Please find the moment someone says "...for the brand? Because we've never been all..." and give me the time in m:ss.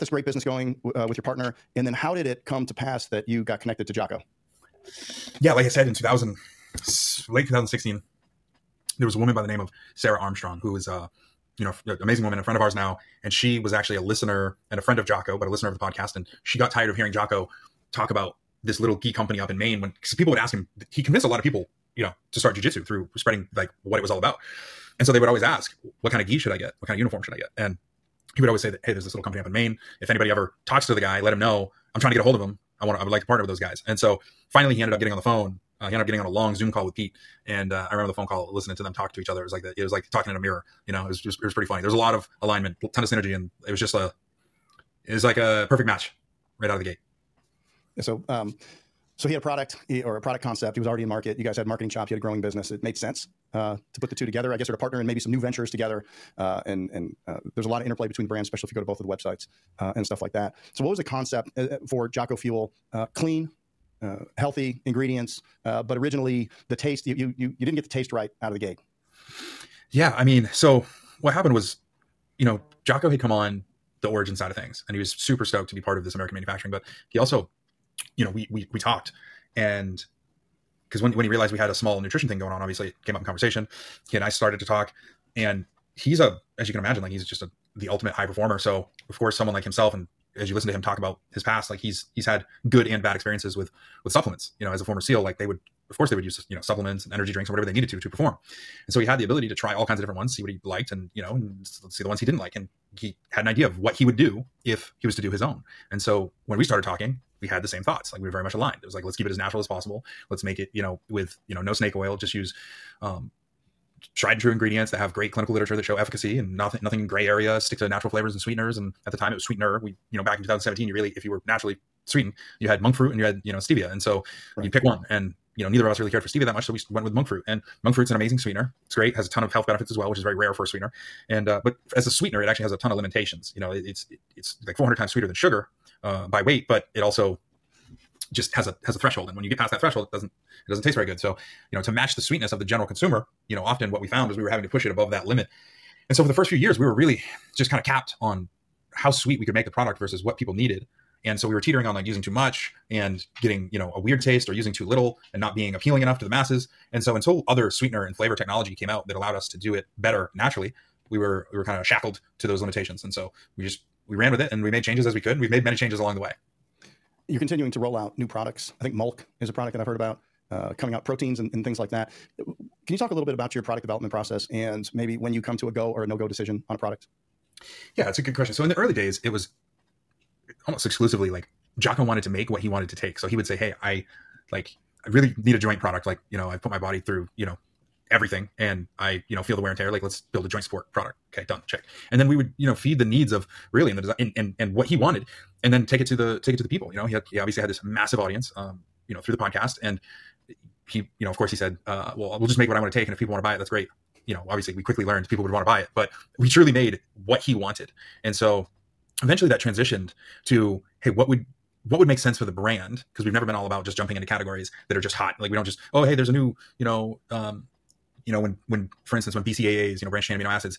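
3:32.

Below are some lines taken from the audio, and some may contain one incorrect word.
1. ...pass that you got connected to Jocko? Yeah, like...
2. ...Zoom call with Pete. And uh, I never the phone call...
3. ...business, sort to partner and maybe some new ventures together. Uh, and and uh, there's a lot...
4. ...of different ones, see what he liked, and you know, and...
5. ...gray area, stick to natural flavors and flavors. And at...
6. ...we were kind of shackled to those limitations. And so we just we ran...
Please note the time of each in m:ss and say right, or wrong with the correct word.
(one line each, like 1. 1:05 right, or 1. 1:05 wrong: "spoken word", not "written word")
1. 0:02 right
2. 0:36 wrong: "remember", not "never"
3. 0:54 wrong: "guess", not "business"
4. 1:39 right
5. 1:57 wrong: "sweeteners", not "flavors"
6. 2:41 right.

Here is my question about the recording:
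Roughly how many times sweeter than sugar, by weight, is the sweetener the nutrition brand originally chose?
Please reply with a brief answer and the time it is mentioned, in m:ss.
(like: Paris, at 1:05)
400, at 2:14.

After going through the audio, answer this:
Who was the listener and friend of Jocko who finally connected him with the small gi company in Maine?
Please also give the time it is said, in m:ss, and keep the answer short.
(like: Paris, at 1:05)
Sarah Armstrong, at 0:09.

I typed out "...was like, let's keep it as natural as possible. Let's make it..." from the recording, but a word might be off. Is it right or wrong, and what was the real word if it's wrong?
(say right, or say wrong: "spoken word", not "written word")
right.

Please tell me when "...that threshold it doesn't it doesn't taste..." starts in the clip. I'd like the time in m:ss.
2:19.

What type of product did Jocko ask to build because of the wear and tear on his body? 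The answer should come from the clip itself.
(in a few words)
Joint support product.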